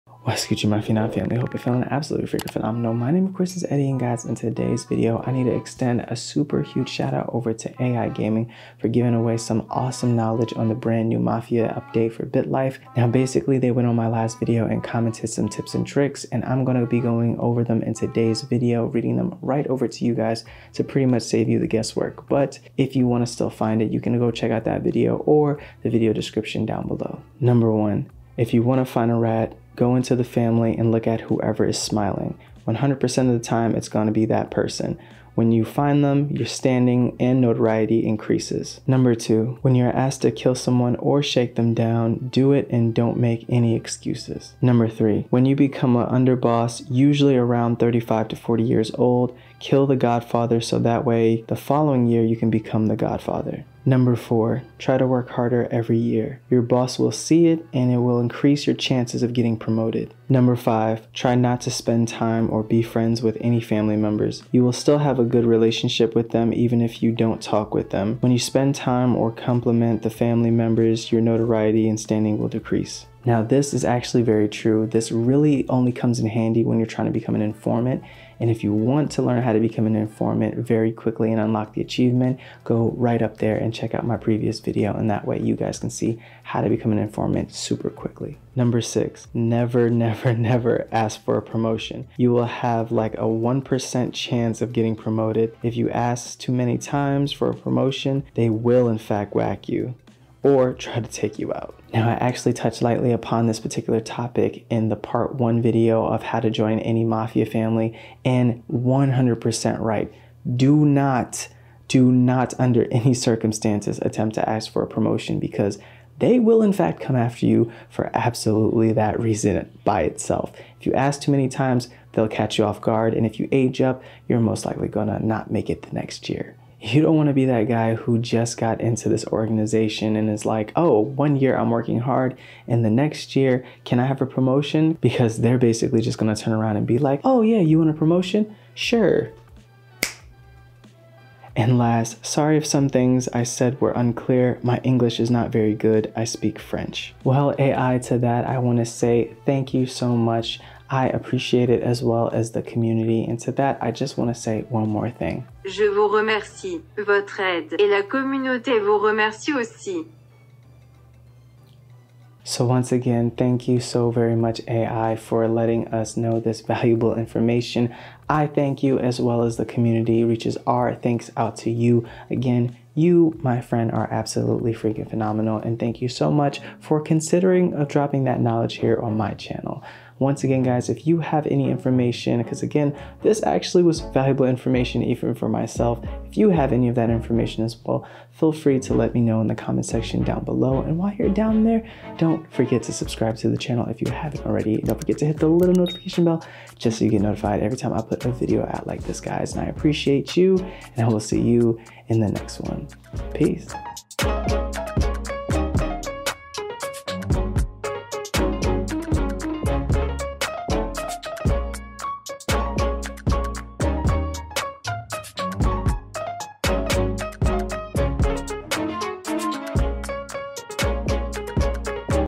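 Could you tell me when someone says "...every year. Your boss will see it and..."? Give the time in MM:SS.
00:55.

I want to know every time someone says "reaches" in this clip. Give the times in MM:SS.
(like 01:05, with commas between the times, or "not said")
02:50.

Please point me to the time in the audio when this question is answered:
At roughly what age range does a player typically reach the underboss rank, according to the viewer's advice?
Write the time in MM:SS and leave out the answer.
00:47.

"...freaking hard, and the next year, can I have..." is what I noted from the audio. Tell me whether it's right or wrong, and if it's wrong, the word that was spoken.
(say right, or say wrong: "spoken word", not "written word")
wrong: "working", not "freaking".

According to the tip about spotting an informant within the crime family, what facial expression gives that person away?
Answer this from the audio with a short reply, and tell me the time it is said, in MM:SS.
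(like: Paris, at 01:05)
Smiling, at 00:31.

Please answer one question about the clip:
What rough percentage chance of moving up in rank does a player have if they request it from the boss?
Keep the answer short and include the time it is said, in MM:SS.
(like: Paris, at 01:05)
1%, at 01:33.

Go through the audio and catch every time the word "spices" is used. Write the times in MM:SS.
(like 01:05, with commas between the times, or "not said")
not said.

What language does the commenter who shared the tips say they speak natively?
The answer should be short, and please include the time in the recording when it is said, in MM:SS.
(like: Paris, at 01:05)
French, at 02:26.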